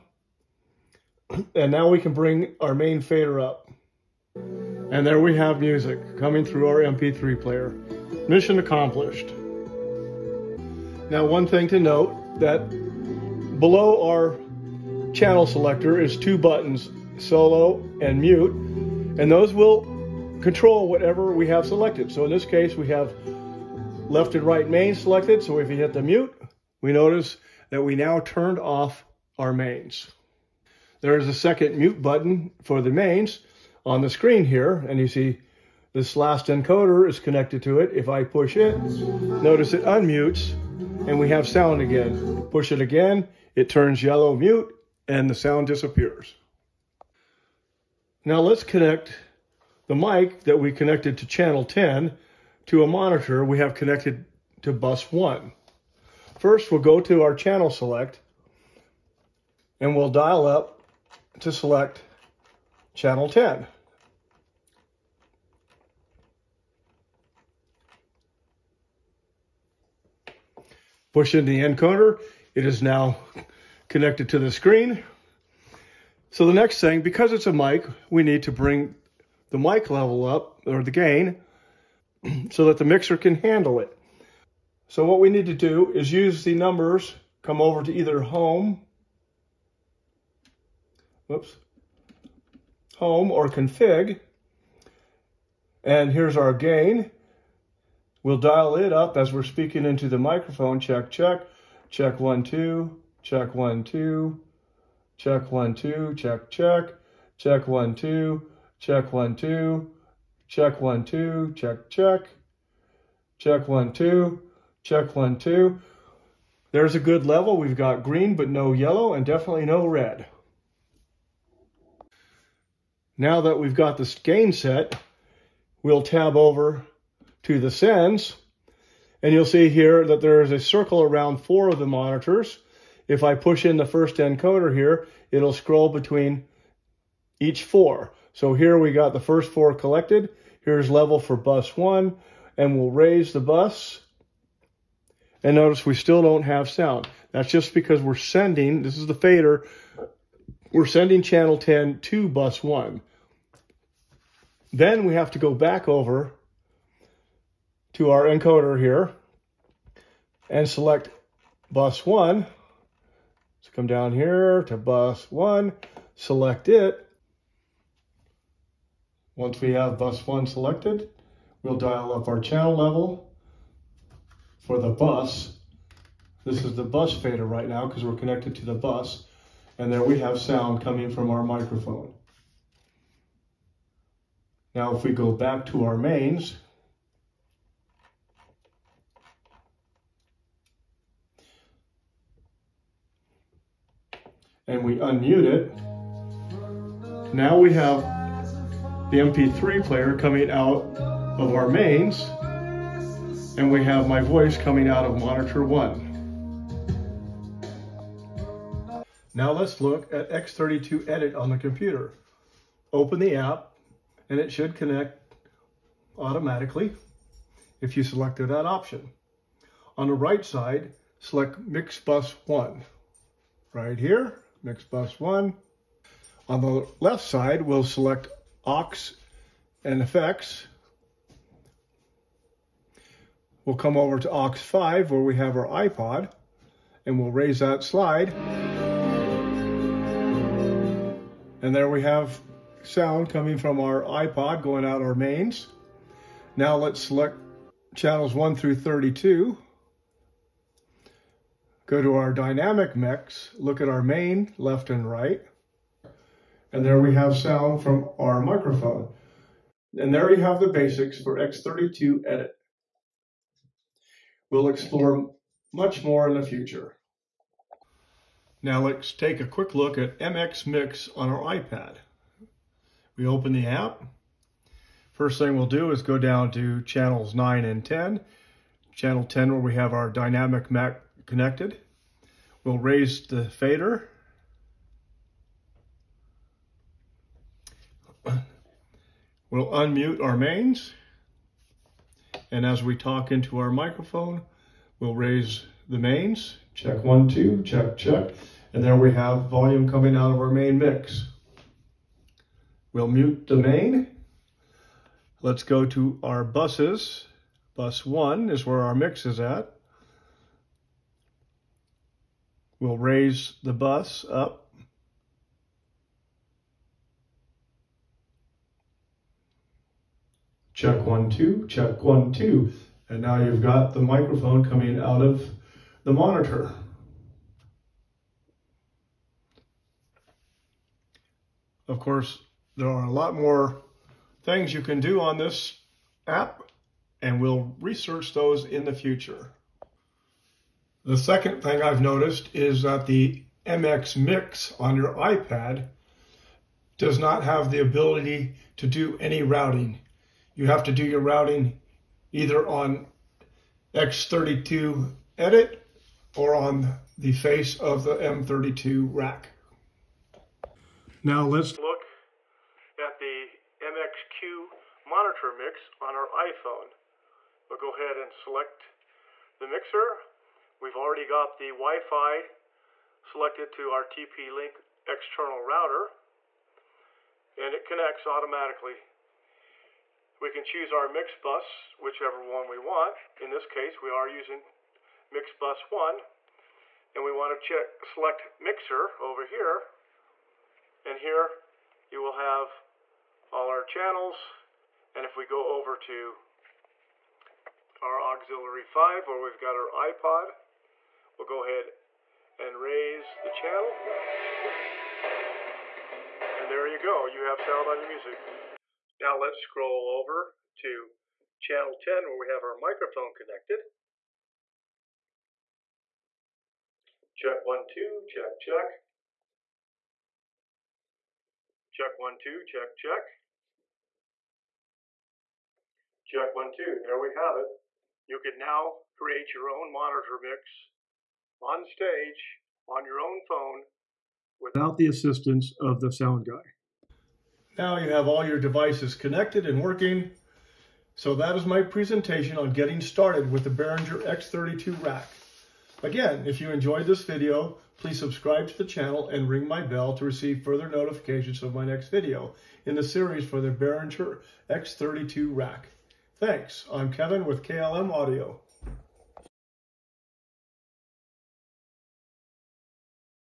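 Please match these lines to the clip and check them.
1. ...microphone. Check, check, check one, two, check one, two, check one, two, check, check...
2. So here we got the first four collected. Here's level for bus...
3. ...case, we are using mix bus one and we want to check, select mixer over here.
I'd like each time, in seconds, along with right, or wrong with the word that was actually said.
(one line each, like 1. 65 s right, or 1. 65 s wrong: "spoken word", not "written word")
1. 100 s right
2. 138 s right
3. 383 s right.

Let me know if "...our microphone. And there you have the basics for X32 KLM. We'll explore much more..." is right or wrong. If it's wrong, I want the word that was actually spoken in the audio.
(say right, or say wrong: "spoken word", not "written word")
wrong: "Edit", not "KLM".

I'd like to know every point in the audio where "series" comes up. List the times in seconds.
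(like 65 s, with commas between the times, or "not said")
453 s.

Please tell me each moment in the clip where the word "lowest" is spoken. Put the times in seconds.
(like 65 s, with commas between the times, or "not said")
not said.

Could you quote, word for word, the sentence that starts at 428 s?
You can now create your own monitor mix on stage on your own phone without the assistance of the sound guy.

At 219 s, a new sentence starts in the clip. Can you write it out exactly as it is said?
On the right side, select Mix Bus 1 right here next bus one.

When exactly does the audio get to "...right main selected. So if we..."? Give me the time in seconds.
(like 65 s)
24 s.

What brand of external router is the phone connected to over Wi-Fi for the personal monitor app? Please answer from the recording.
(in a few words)
TP-Link.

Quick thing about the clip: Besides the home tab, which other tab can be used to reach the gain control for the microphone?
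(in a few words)
Config.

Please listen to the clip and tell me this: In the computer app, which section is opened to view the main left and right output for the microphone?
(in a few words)
Dynamic mix.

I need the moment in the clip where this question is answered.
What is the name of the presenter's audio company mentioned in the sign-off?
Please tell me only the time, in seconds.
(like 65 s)
457 s.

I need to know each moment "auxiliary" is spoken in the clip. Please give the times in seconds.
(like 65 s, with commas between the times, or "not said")
398 s.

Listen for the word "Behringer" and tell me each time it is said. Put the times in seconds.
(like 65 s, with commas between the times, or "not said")
443 s, 453 s.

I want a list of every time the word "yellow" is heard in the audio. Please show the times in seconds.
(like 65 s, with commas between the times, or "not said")
44 s, 118 s.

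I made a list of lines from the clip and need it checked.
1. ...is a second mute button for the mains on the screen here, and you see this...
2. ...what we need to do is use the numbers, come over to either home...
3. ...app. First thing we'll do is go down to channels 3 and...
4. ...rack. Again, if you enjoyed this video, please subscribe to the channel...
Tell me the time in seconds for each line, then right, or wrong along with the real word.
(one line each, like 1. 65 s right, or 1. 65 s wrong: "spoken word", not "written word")
1. 31 s right
2. 85 s right
3. 273 s wrong: "9", not "3"
4. 445 s right.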